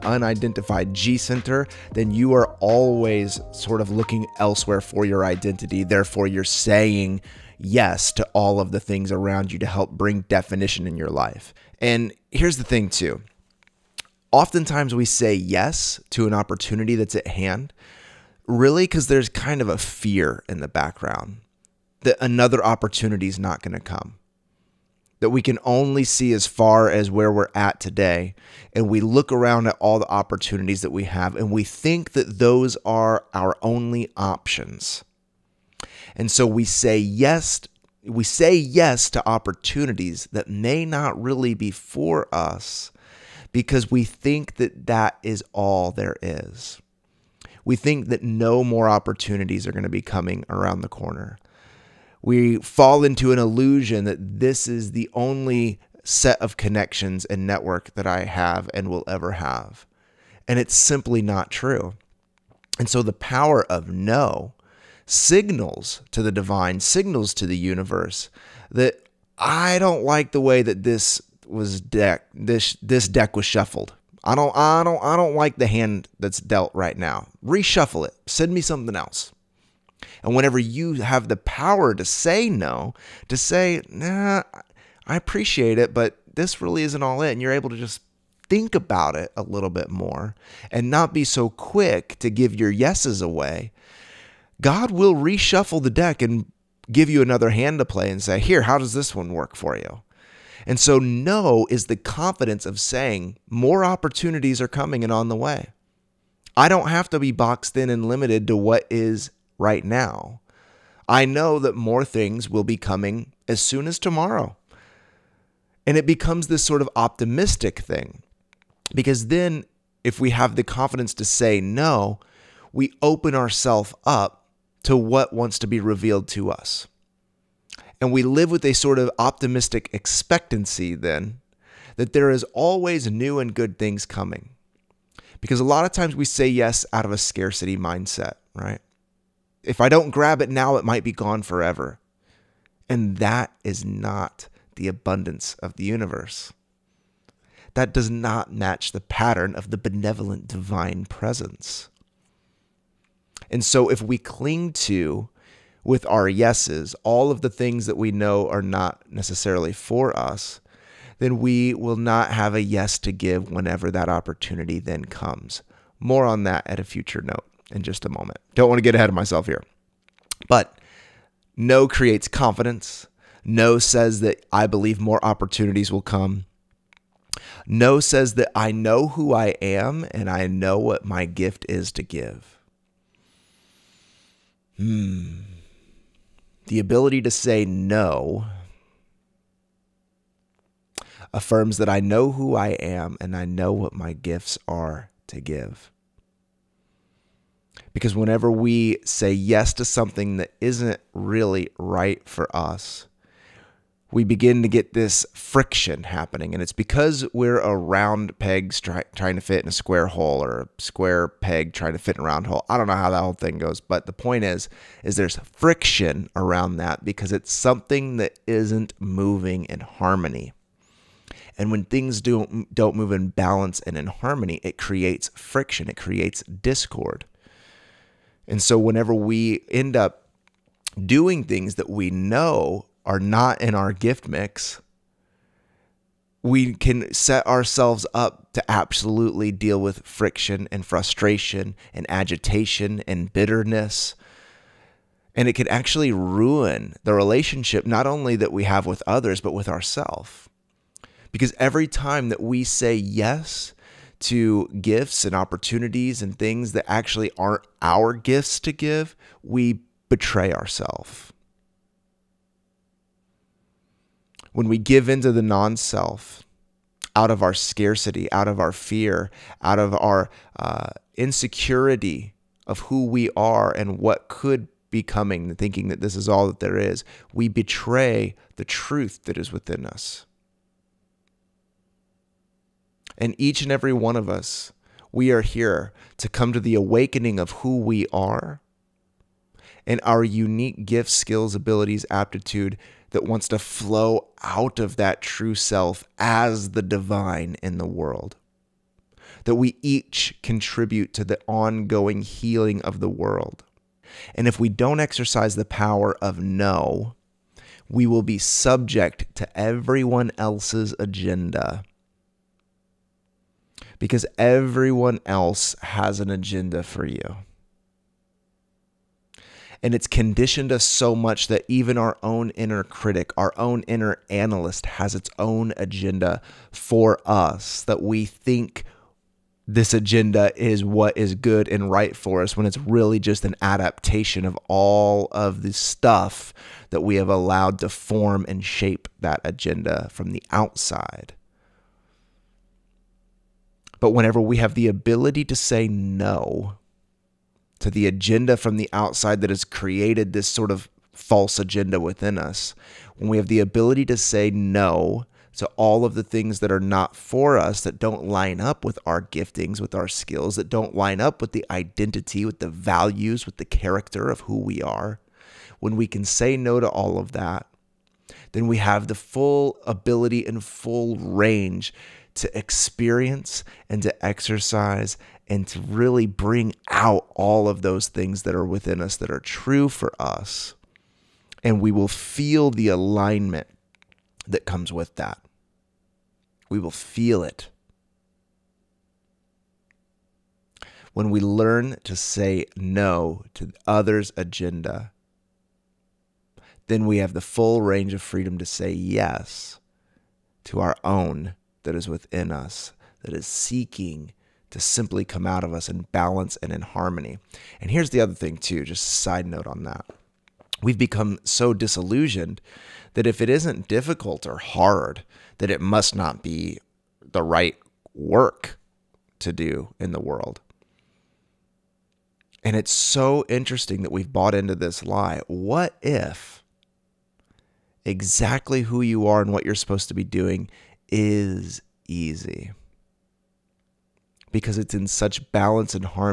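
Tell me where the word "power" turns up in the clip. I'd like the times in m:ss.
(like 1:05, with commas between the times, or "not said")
1:03, 1:21, 5:05.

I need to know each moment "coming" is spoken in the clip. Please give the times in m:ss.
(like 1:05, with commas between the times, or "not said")
0:50, 1:44, 1:52, 2:14, 4:35.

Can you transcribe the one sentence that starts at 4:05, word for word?
And it can actually ruin the relationship, not only that we have with others, but with ourselves.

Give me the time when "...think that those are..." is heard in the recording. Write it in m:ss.
0:31.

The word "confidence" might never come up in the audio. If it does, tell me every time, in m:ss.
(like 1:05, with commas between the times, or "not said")
1:41, 2:00, 2:52.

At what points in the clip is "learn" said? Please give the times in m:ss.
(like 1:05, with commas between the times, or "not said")
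6:31.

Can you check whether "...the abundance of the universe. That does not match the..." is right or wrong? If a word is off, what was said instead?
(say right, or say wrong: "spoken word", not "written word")
right.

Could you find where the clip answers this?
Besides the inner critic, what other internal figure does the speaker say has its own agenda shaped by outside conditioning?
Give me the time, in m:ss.
5:23.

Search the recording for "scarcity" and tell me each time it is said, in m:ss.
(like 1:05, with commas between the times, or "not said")
2:17, 4:27.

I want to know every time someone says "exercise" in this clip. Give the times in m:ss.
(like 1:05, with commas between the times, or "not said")
5:04, 6:14.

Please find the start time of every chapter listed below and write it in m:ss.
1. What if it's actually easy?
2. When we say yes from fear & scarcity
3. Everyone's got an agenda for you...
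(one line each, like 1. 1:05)
1. 6:47
2. 0:11
3. 5:03.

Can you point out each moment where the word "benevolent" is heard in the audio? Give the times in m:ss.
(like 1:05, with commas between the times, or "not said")
2:29.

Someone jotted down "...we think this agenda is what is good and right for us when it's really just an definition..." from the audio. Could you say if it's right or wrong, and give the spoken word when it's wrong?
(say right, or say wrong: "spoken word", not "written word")
wrong: "adaptation", not "definition".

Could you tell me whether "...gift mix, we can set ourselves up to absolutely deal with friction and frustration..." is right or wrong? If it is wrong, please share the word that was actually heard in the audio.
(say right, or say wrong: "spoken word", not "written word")
right.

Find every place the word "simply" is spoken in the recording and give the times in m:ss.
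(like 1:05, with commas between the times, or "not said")
1:00, 6:44.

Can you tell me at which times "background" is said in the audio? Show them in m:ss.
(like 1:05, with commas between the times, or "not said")
0:20.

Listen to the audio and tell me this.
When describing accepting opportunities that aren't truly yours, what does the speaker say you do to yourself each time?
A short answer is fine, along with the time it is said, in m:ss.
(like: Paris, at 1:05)
Betray ourselves, at 4:19.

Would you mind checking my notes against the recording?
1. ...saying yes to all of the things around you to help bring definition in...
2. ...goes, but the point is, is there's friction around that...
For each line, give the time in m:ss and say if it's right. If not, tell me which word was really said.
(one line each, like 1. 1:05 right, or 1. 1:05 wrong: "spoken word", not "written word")
1. 0:06 right
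2. 3:33 right.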